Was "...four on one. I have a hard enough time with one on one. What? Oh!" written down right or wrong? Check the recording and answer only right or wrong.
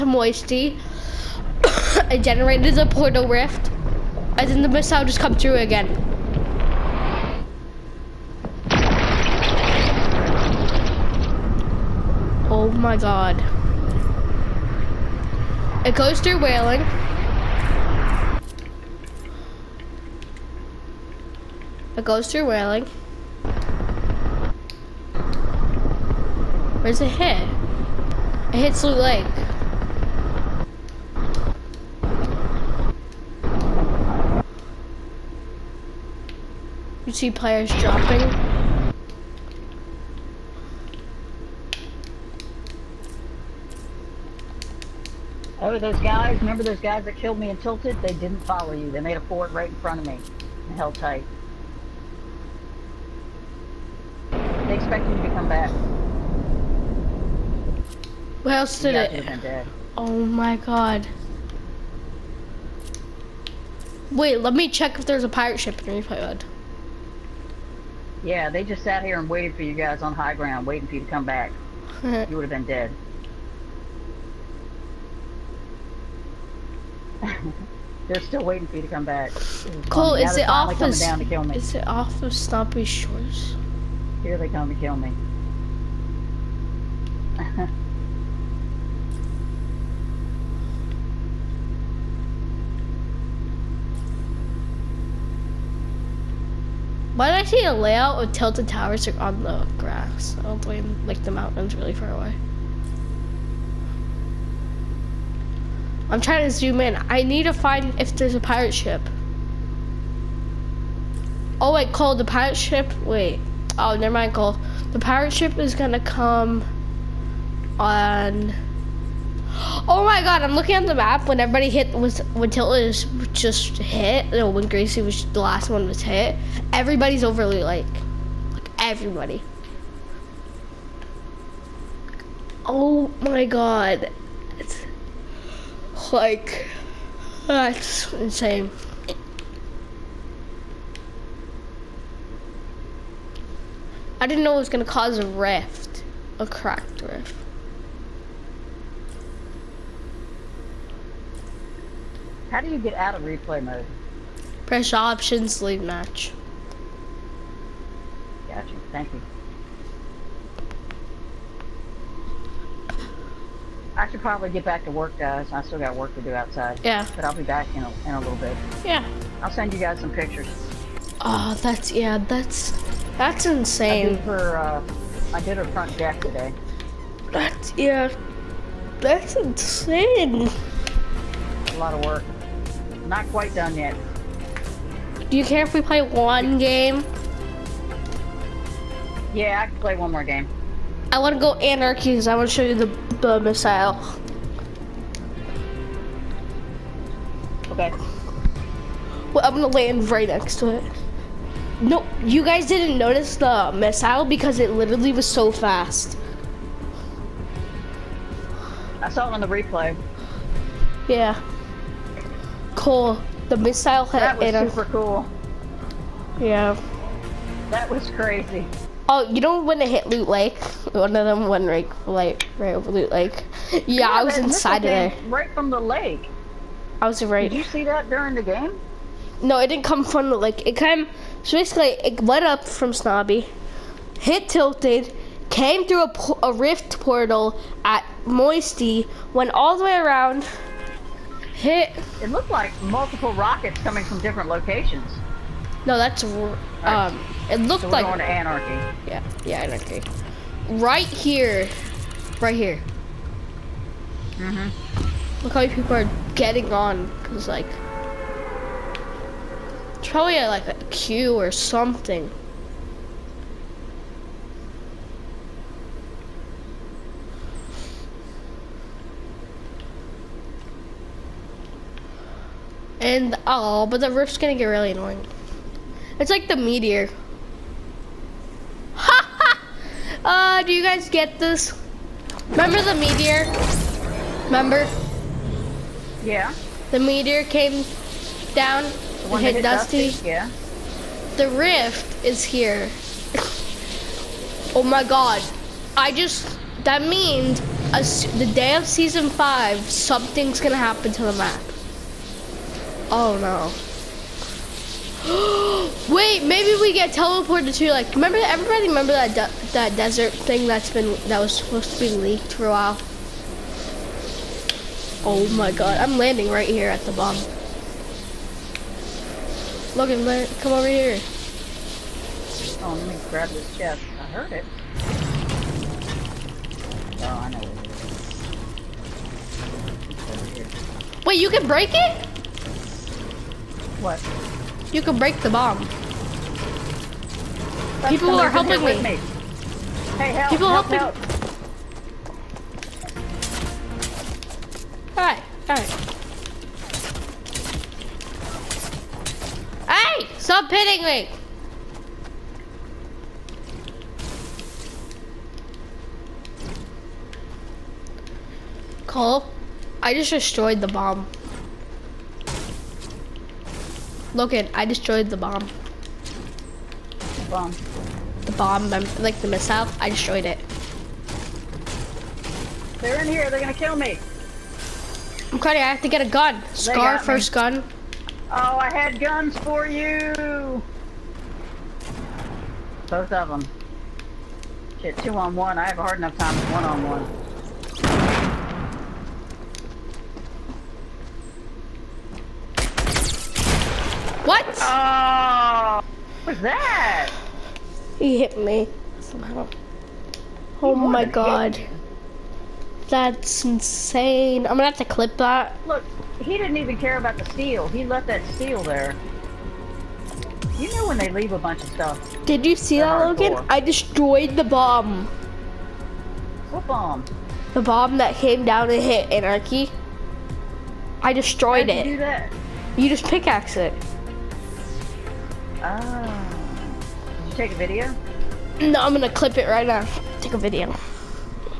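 wrong.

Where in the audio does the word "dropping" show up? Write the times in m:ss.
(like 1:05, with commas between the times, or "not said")
0:37.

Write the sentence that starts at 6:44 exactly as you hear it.
I'm gonna have to clip that.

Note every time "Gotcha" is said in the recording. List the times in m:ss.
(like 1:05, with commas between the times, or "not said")
2:38.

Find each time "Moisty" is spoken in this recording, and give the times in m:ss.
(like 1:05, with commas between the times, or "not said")
0:00, 3:58.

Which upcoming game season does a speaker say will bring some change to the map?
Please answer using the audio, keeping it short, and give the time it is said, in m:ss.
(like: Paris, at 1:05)
season 5, at 4:58.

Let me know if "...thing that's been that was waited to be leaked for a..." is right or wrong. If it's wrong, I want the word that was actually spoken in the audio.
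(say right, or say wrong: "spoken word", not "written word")
wrong: "supposed", not "waited".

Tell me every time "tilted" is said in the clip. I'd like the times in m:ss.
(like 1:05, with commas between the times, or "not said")
0:47, 1:38, 2:02, 3:54.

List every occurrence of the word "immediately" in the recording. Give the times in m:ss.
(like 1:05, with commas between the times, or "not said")
not said.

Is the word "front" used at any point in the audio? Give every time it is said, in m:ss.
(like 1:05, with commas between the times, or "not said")
0:49, 2:55.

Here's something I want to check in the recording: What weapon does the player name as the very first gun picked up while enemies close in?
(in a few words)
Scar.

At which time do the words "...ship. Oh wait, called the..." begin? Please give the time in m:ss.
1:48.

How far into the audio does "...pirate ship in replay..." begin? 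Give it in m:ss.
1:05.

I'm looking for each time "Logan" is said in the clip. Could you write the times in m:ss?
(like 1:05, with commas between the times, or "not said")
5:19, 6:04, 6:53.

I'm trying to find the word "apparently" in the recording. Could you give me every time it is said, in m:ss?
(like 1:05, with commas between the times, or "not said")
not said.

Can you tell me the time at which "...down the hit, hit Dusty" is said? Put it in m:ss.
4:48.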